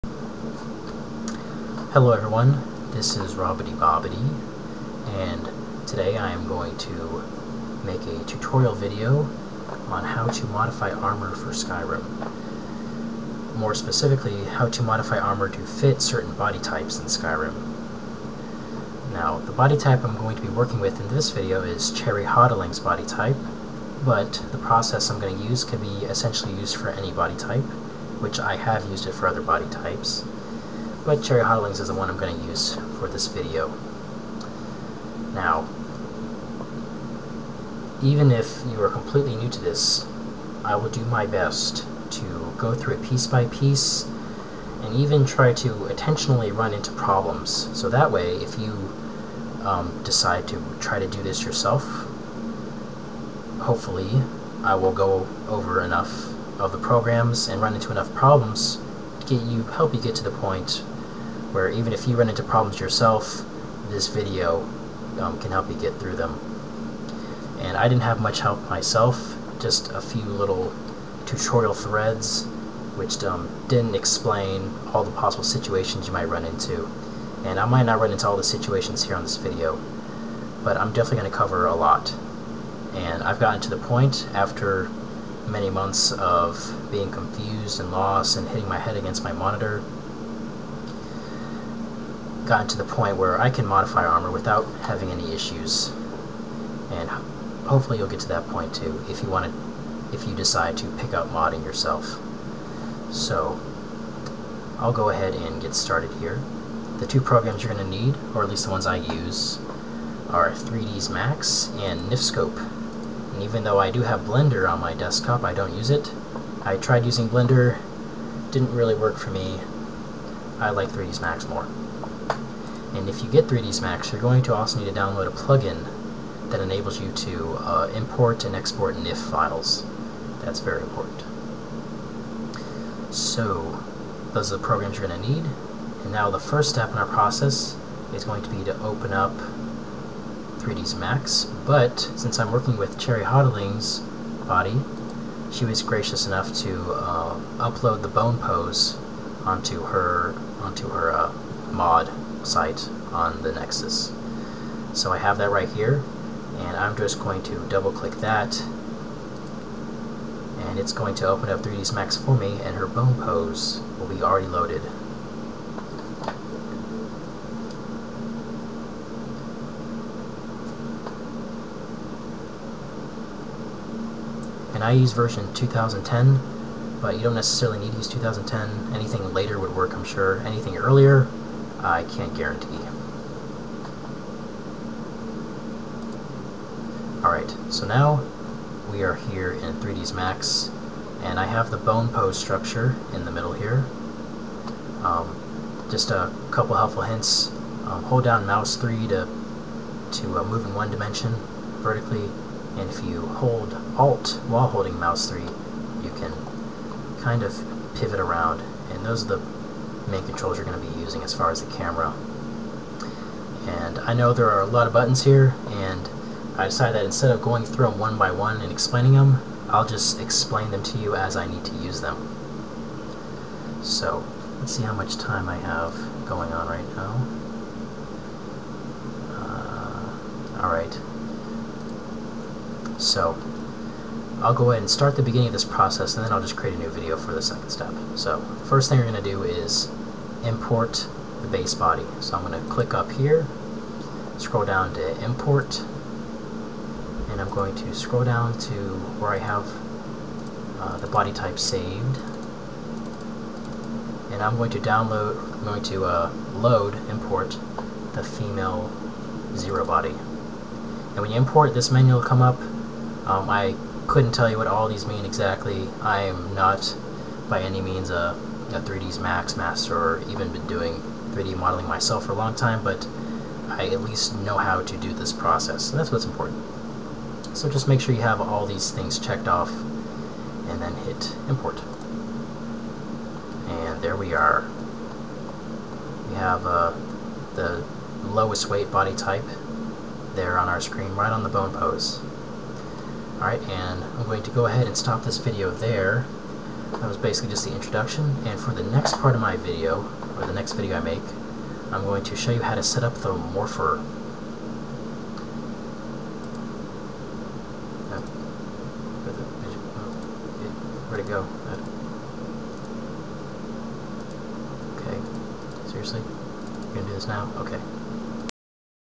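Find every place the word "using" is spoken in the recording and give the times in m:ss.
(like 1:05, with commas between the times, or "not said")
1:57, 3:30.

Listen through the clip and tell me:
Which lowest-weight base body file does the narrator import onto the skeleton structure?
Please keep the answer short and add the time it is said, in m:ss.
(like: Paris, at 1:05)
female zero body, at 4:18.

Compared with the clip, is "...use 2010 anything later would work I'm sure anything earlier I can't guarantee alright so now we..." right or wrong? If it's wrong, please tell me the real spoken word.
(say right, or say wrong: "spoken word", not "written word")
right.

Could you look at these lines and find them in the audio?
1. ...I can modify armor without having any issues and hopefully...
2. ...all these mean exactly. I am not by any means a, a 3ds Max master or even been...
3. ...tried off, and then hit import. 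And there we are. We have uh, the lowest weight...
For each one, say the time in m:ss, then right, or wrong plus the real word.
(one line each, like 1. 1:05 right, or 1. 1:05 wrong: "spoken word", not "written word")
1. 1:33 right
2. 4:24 right
3. 4:39 wrong: "checked", not "tried".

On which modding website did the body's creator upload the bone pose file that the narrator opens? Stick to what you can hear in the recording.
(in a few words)
the Nexus.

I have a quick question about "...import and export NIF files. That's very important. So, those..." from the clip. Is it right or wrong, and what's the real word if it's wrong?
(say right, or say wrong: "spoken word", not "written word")
right.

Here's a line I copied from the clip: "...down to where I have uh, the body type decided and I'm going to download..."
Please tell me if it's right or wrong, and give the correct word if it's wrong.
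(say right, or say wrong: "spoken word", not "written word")
wrong: "saved", not "decided".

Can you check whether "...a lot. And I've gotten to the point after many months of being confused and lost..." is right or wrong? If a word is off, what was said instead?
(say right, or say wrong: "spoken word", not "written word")
right.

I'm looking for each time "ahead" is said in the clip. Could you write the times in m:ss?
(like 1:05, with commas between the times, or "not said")
1:45, 3:54, 4:54.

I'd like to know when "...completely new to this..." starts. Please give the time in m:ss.
0:38.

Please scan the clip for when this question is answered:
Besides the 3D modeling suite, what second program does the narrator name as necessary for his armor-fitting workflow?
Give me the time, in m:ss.
1:52.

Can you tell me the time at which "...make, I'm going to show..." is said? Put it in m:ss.
5:00.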